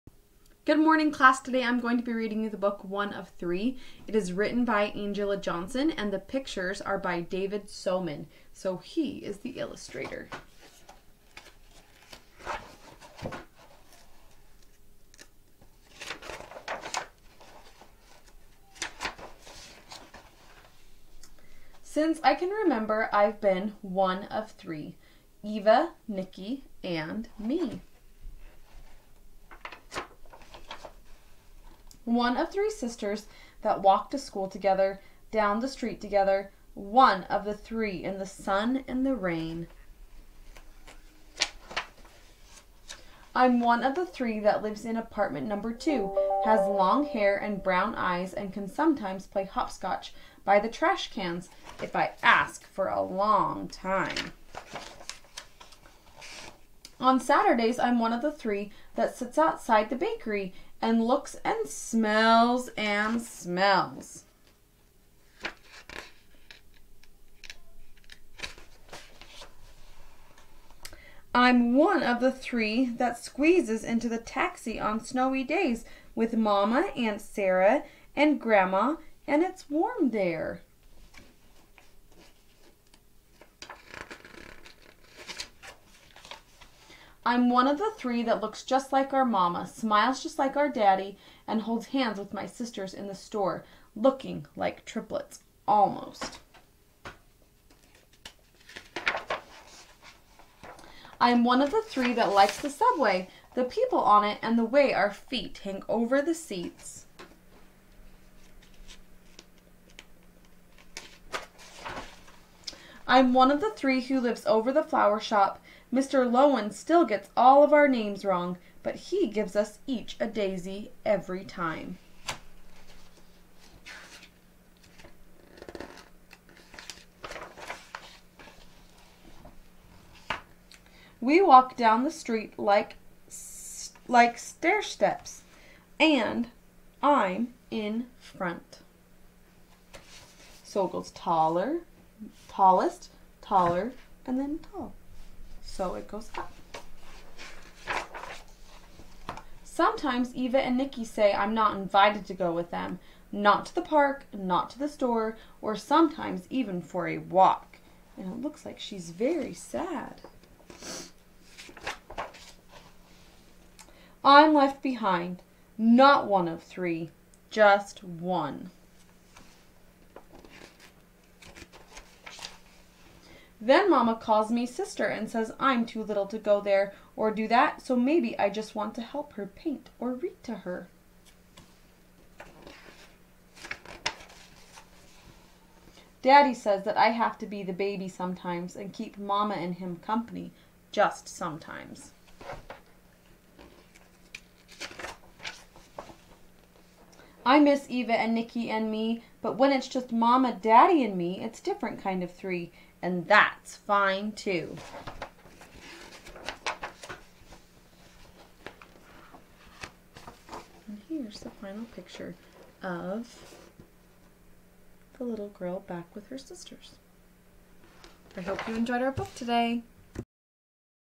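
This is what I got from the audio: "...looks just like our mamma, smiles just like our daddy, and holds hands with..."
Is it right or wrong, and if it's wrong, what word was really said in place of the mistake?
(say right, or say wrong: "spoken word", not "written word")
right.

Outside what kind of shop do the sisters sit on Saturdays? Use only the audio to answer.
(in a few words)
the bakery.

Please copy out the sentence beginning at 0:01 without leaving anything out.
Today I'm going to be reading you the book One of Three.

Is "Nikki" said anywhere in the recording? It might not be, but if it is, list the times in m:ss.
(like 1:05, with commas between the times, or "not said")
0:26, 2:30, 3:18.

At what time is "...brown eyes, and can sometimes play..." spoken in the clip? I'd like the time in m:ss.
0:47.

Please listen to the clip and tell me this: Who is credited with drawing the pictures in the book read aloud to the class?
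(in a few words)
David Soman.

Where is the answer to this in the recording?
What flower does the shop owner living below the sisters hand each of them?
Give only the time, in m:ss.
2:00.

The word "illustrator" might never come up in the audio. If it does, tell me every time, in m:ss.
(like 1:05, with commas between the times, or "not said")
0:09.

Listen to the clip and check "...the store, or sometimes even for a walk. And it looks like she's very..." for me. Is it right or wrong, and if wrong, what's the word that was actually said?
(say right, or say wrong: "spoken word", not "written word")
right.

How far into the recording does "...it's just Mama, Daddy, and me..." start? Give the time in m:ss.
3:19.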